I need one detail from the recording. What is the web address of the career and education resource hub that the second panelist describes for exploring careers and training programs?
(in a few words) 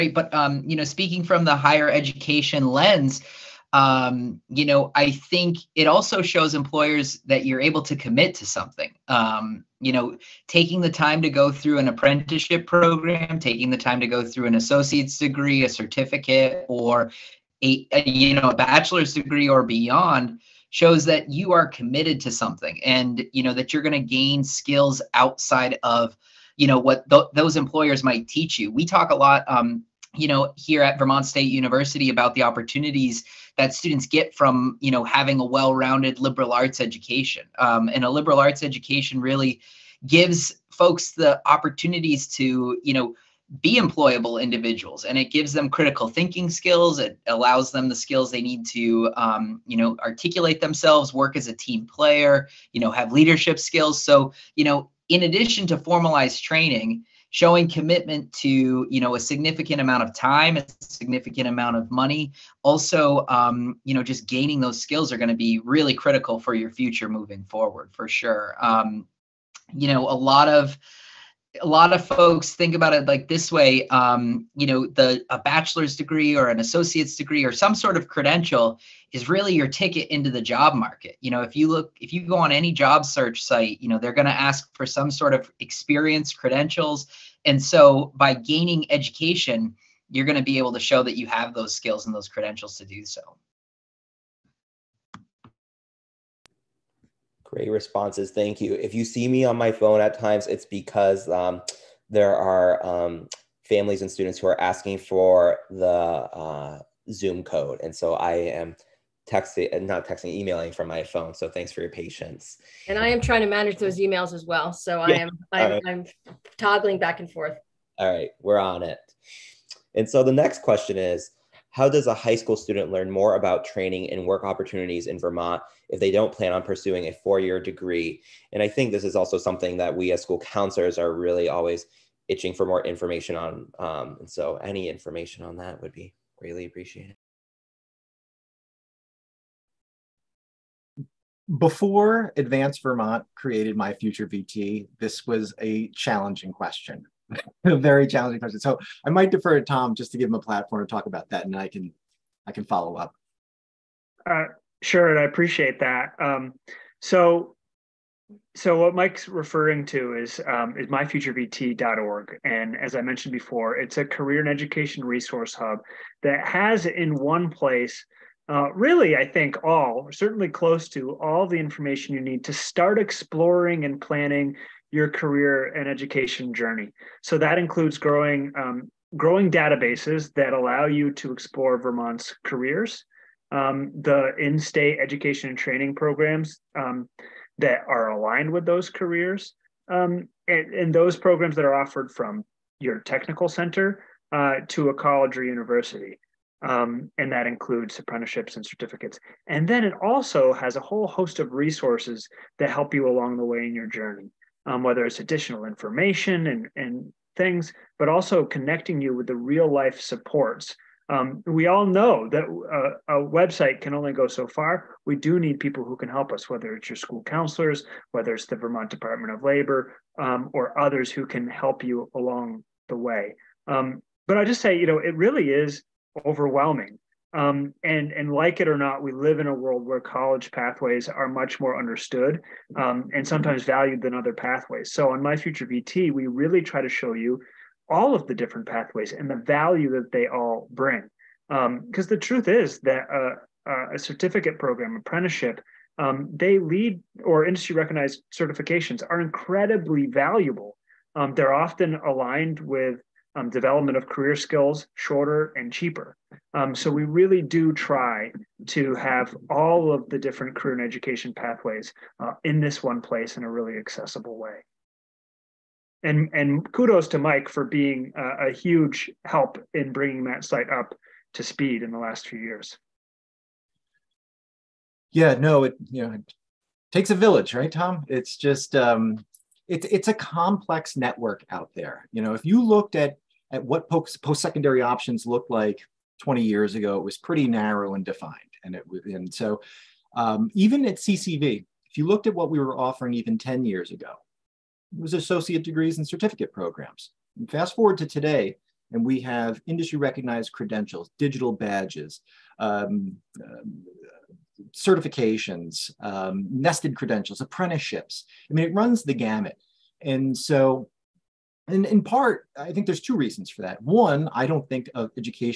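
myfuturevt.org.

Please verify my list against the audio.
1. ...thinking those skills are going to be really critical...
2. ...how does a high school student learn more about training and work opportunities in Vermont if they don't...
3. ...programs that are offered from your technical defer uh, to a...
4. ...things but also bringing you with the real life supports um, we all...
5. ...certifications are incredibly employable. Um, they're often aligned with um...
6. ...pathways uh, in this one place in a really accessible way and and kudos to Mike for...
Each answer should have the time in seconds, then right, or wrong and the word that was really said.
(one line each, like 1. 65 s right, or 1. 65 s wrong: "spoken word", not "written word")
1. 64 s wrong: "gaining", not "thinking"
2. 121 s right
3. 191 s wrong: "center", not "defer"
4. 207 s wrong: "connecting", not "bringing"
5. 248 s wrong: "valuable", not "employable"
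6. 261 s right.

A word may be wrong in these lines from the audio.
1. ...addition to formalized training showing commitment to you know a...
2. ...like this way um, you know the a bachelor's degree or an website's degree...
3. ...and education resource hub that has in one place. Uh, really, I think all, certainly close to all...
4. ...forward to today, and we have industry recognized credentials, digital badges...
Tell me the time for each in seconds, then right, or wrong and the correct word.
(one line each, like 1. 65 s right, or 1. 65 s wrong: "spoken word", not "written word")
1. 55 s right
2. 73 s wrong: "associate", not "website"
3. 164 s right
4. 297 s right.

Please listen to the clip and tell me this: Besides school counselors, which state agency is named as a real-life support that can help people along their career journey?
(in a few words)
Vermont Department of Labor.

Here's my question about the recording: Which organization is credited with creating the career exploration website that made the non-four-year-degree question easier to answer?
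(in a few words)
Advanced Vermont.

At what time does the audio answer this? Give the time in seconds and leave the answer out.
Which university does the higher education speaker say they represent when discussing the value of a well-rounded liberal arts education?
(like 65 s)
30 s.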